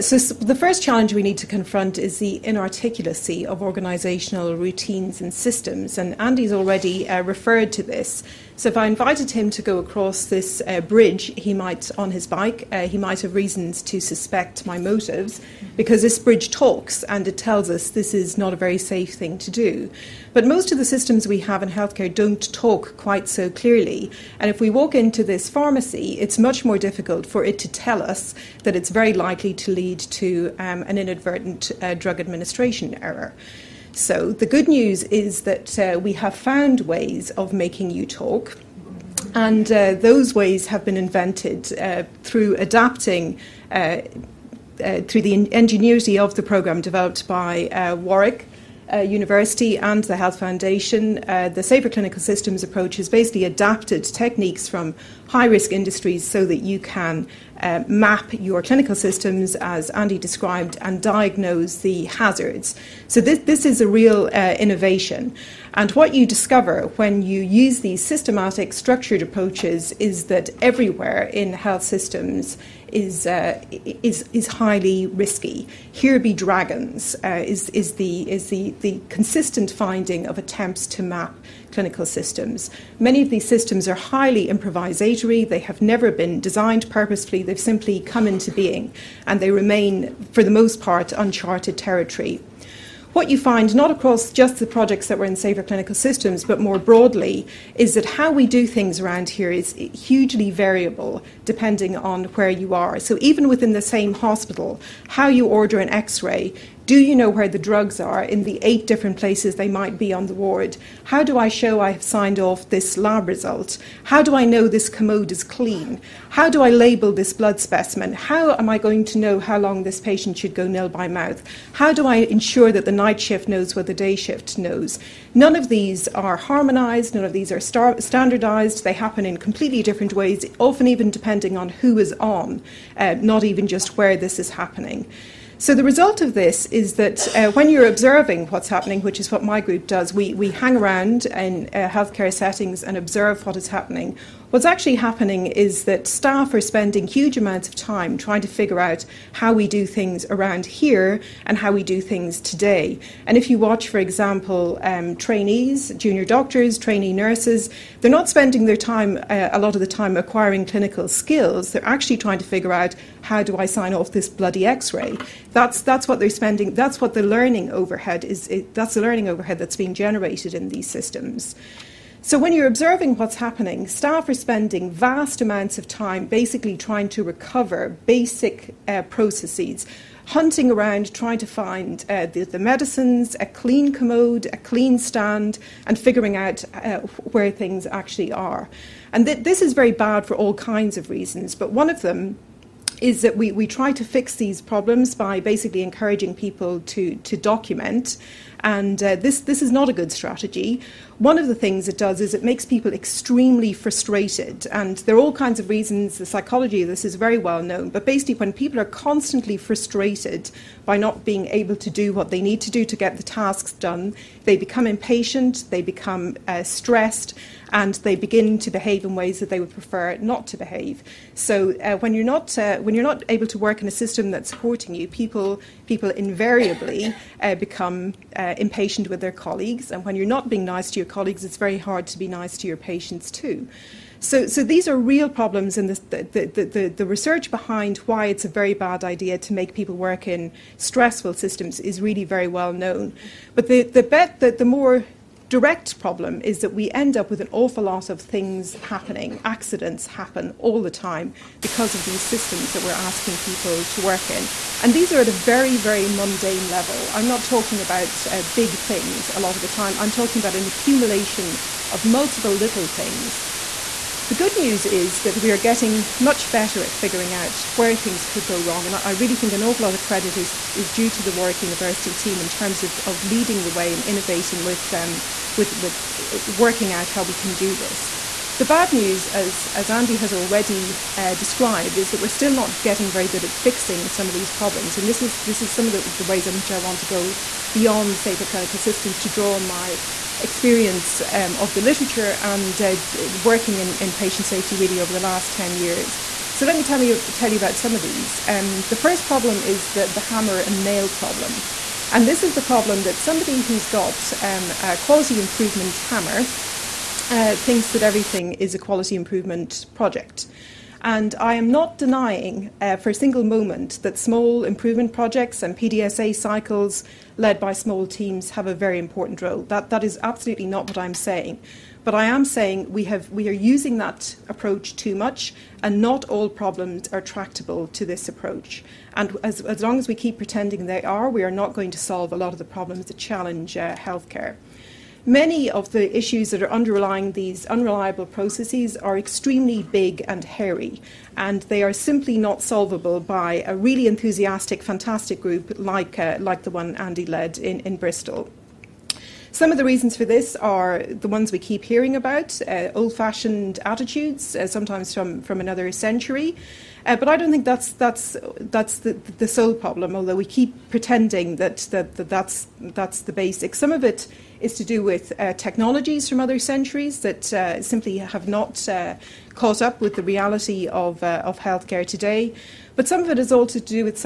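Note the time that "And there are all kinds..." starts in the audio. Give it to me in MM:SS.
03:24.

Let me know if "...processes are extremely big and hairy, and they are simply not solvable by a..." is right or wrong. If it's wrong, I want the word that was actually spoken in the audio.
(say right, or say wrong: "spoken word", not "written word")
right.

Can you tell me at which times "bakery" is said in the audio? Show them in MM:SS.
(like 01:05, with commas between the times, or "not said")
not said.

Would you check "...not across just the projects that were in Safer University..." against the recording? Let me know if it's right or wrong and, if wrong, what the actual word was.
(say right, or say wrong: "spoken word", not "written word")
wrong: "Clinical", not "University".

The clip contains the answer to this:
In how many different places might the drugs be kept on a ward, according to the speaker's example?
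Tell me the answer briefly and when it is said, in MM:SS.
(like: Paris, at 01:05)
8, at 01:48.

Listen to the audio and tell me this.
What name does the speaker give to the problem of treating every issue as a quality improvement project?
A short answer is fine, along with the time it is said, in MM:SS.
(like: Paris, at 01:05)
hammer and nail problem, at 05:00.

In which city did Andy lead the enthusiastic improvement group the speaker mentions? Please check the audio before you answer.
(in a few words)
Bristol.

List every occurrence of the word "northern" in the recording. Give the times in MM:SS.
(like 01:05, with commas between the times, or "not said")
not said.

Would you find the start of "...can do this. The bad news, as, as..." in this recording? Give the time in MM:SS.
04:37.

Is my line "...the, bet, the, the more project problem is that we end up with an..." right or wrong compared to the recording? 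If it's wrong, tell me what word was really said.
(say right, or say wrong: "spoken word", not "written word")
wrong: "direct", not "project".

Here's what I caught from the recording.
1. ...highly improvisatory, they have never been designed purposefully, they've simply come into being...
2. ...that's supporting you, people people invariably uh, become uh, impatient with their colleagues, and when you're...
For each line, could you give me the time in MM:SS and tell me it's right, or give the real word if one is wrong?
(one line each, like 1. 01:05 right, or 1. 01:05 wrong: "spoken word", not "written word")
1. 01:23 right
2. 03:44 right.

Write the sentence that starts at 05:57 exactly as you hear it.
Uh, but I don't think that's that's that's the, the sole problem.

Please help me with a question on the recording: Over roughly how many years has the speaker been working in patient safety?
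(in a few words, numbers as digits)
10.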